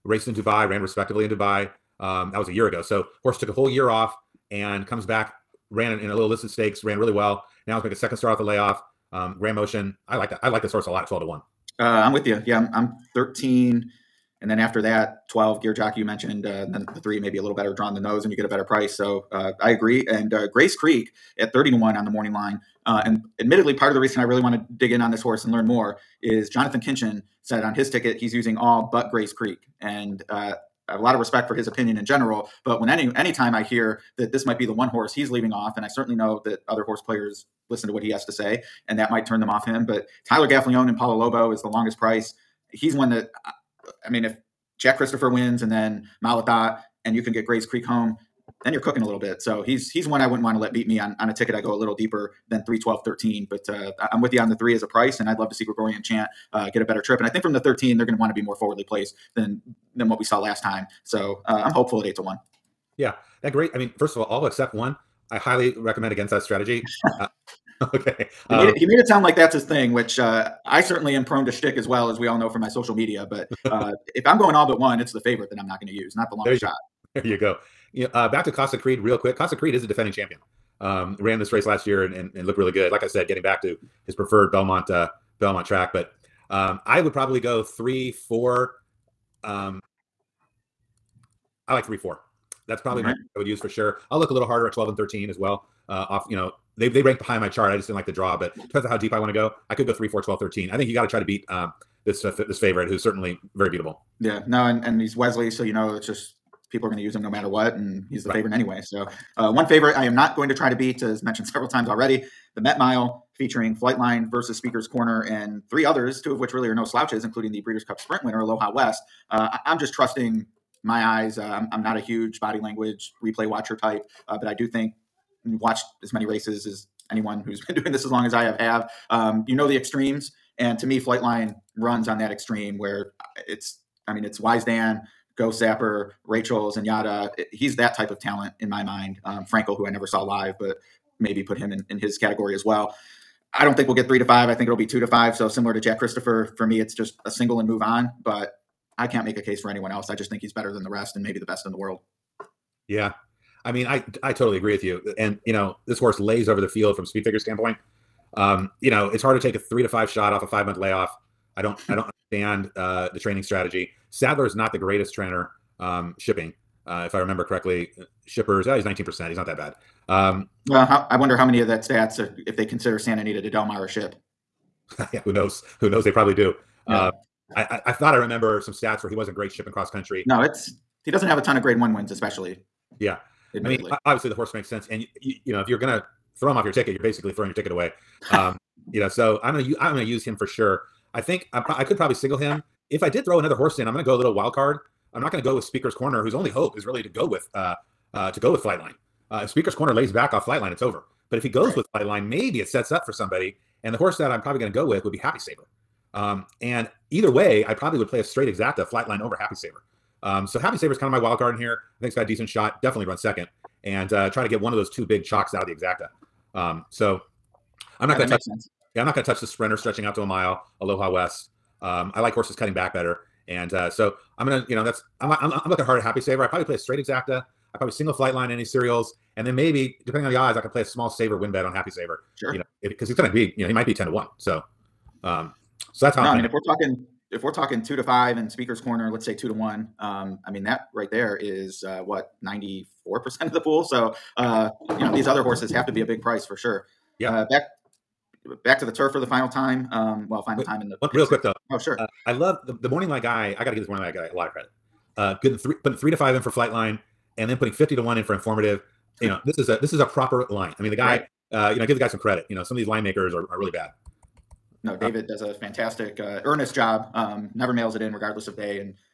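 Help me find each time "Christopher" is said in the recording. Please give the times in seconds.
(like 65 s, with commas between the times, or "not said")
44 s, 145 s.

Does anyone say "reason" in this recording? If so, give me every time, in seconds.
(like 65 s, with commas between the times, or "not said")
23 s.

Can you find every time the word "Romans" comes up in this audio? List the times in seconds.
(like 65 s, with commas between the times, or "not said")
not said.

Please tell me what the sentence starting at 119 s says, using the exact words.
Uh, I, am just trusting my eyes.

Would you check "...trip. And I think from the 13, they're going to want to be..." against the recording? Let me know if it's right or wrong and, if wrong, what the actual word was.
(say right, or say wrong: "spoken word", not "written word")
right.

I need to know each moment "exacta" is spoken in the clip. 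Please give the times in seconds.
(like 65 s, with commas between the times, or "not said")
208 s, 215 s, 226 s.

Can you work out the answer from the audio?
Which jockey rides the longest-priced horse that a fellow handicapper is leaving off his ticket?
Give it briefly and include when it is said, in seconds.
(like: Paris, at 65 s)
Tyler Gaffalione, at 40 s.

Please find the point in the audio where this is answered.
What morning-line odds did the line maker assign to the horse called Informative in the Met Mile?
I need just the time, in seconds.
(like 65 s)
257 s.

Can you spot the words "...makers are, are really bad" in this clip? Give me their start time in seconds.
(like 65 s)
263 s.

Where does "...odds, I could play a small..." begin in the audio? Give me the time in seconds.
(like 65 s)
230 s.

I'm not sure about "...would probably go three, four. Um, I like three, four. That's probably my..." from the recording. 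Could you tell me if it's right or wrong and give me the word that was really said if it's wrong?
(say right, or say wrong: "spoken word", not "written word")
right.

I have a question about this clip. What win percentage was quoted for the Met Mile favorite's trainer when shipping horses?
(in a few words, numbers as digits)
19%.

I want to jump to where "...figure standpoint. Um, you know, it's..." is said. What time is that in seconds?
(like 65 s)
157 s.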